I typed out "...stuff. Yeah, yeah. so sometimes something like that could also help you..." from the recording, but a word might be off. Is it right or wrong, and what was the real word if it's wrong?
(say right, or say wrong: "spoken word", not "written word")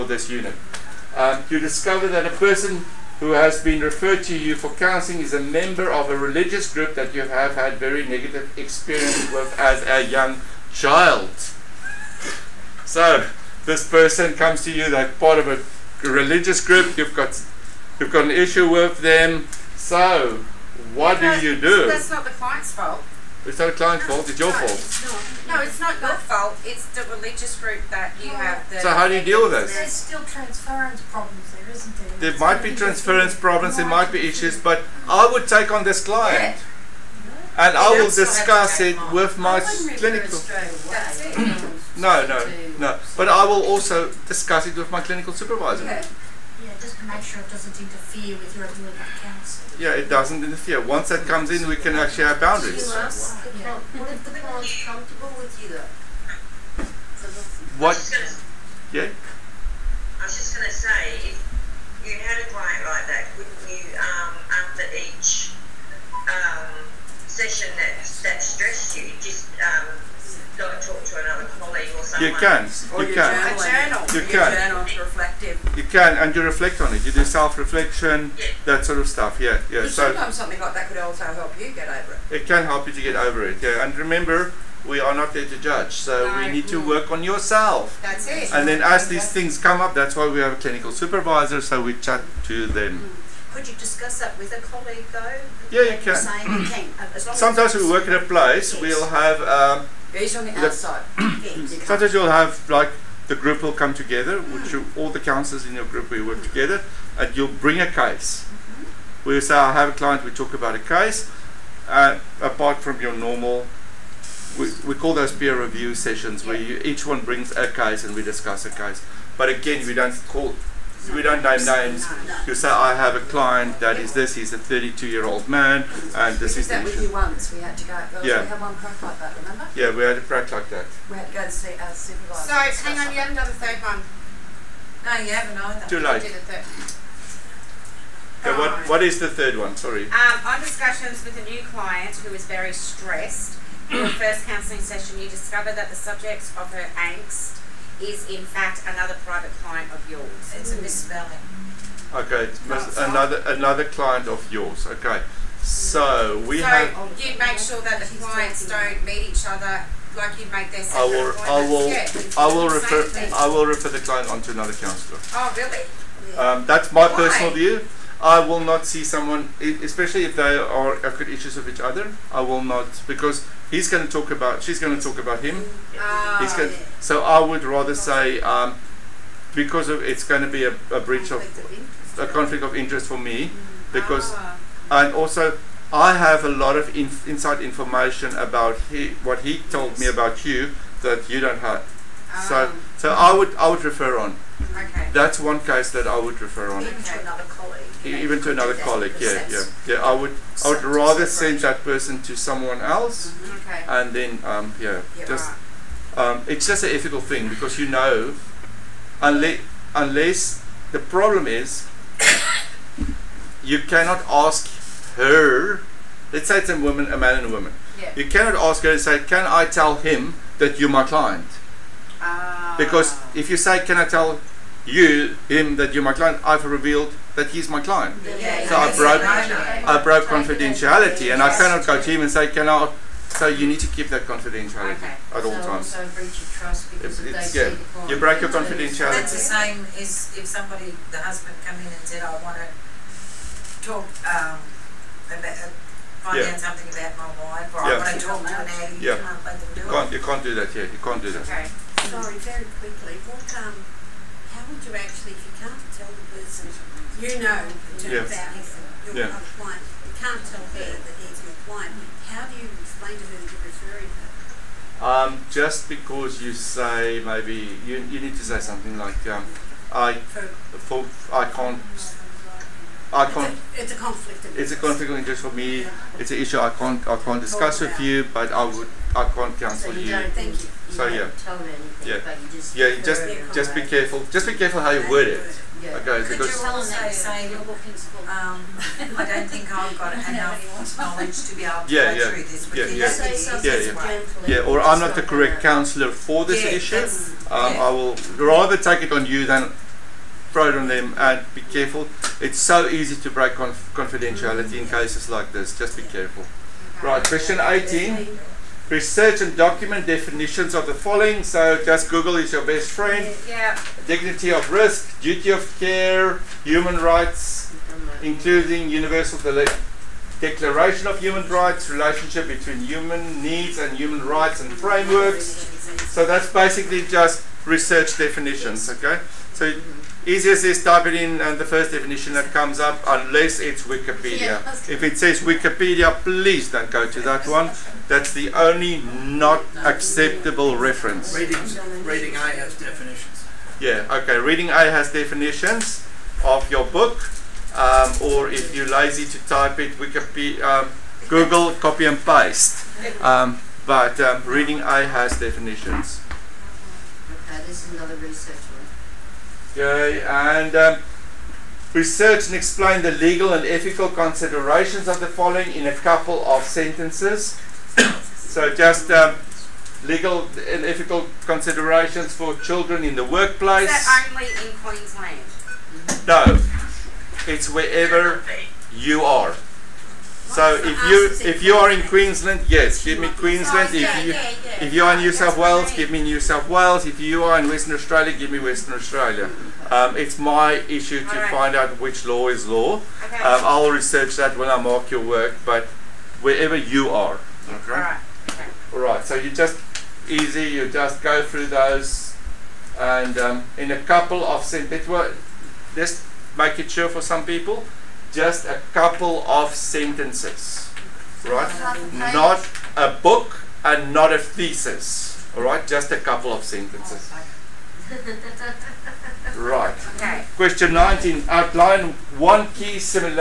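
right.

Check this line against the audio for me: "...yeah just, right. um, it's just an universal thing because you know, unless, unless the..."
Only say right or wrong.
wrong.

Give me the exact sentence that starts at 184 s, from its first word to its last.
and also I have a lot of inf inside information about he, what he told yes.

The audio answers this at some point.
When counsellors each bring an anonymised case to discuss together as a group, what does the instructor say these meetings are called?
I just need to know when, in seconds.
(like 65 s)
115 s.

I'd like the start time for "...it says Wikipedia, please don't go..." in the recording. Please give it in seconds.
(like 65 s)
335 s.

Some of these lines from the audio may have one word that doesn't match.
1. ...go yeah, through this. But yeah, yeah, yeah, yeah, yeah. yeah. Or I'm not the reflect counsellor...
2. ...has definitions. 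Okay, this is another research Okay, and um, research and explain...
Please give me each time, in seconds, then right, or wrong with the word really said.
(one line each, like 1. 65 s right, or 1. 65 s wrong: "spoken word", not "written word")
1. 292 s wrong: "correct", not "reflect"
2. 354 s right.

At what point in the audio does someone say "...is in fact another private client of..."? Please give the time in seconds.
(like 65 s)
148 s.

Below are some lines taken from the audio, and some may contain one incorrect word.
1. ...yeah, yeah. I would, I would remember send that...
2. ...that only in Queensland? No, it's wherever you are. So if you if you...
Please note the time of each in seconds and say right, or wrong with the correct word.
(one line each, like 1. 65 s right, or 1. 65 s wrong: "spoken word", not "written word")
1. 199 s wrong: "rather", not "remember"
2. 374 s right.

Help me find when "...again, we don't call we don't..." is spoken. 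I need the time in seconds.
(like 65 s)
119 s.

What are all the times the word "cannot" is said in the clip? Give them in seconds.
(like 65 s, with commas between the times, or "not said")
213 s, 218 s, 231 s.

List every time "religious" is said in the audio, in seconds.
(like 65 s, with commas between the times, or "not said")
6 s, 16 s, 27 s.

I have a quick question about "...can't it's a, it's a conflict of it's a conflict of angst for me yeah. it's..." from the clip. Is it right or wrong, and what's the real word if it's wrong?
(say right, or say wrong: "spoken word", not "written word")
wrong: "interest", not "angst".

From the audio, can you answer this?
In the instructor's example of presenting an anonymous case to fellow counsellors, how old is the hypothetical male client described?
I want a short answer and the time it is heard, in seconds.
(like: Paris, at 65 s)
32, at 124 s.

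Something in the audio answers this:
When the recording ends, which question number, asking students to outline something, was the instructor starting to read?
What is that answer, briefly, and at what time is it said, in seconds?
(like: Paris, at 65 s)
19, at 420 s.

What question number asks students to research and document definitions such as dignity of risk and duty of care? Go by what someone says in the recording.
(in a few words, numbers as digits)
18.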